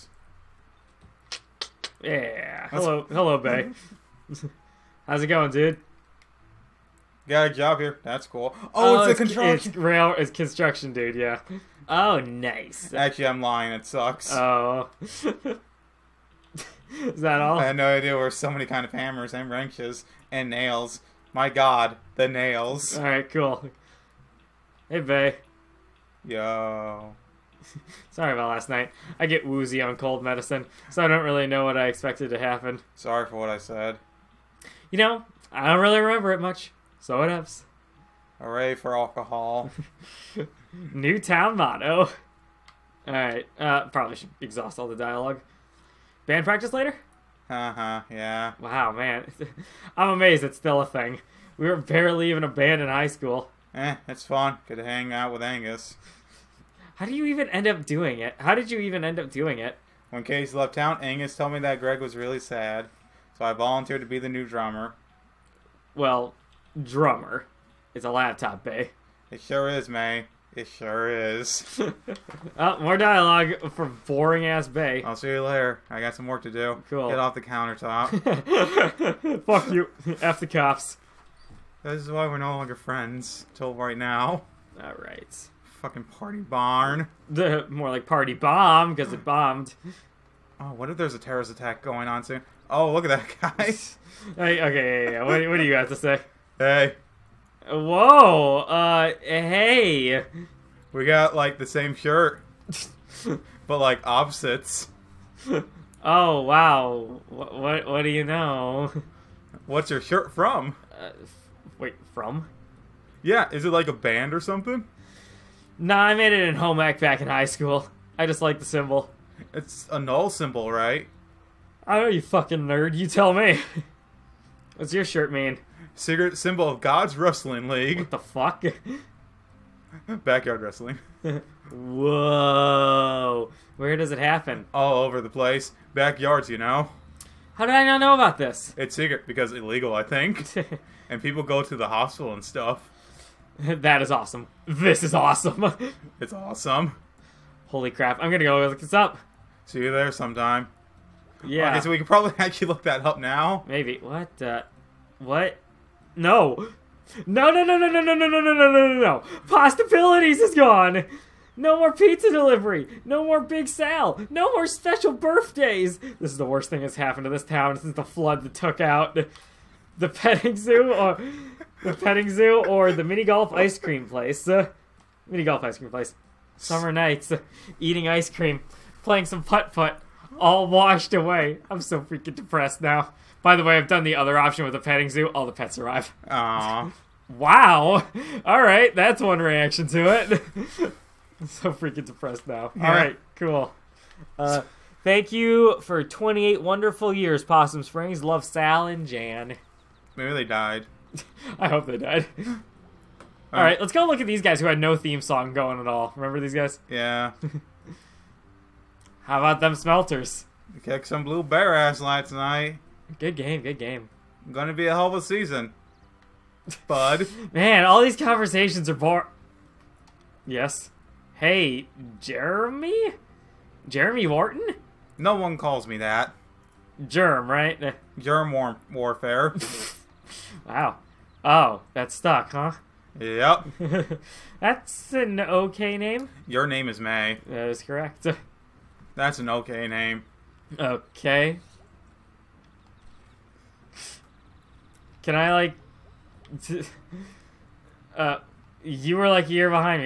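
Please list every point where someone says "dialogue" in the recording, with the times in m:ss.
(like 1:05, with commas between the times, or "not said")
0:44, 1:12.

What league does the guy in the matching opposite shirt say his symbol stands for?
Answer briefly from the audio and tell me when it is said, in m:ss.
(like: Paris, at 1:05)
God's Wrestling League, at 2:06.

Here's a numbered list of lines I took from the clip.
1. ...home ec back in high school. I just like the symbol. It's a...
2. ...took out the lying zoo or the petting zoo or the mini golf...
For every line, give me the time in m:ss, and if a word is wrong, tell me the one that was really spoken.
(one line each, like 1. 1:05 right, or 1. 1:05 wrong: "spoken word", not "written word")
1. 1:56 right
2. 2:48 wrong: "petting", not "lying".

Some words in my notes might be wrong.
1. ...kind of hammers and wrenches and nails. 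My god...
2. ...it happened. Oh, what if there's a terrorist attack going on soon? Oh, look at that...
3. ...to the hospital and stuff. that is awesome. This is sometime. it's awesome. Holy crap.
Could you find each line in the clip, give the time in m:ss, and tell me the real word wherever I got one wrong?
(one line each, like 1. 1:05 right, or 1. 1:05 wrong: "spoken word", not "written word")
1. 0:18 right
2. 1:29 wrong: "bombed", not "happened"
3. 2:21 wrong: "awesome", not "sometime".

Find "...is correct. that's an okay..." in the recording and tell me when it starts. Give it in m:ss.
3:57.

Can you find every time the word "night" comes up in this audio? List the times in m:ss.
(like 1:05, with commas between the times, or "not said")
0:28, 2:56, 3:32.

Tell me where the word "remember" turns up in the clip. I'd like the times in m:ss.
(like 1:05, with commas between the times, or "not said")
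0:36, 3:26.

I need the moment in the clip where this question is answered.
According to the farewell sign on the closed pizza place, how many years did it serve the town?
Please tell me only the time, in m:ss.
3:16.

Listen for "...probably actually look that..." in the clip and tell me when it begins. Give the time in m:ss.
2:32.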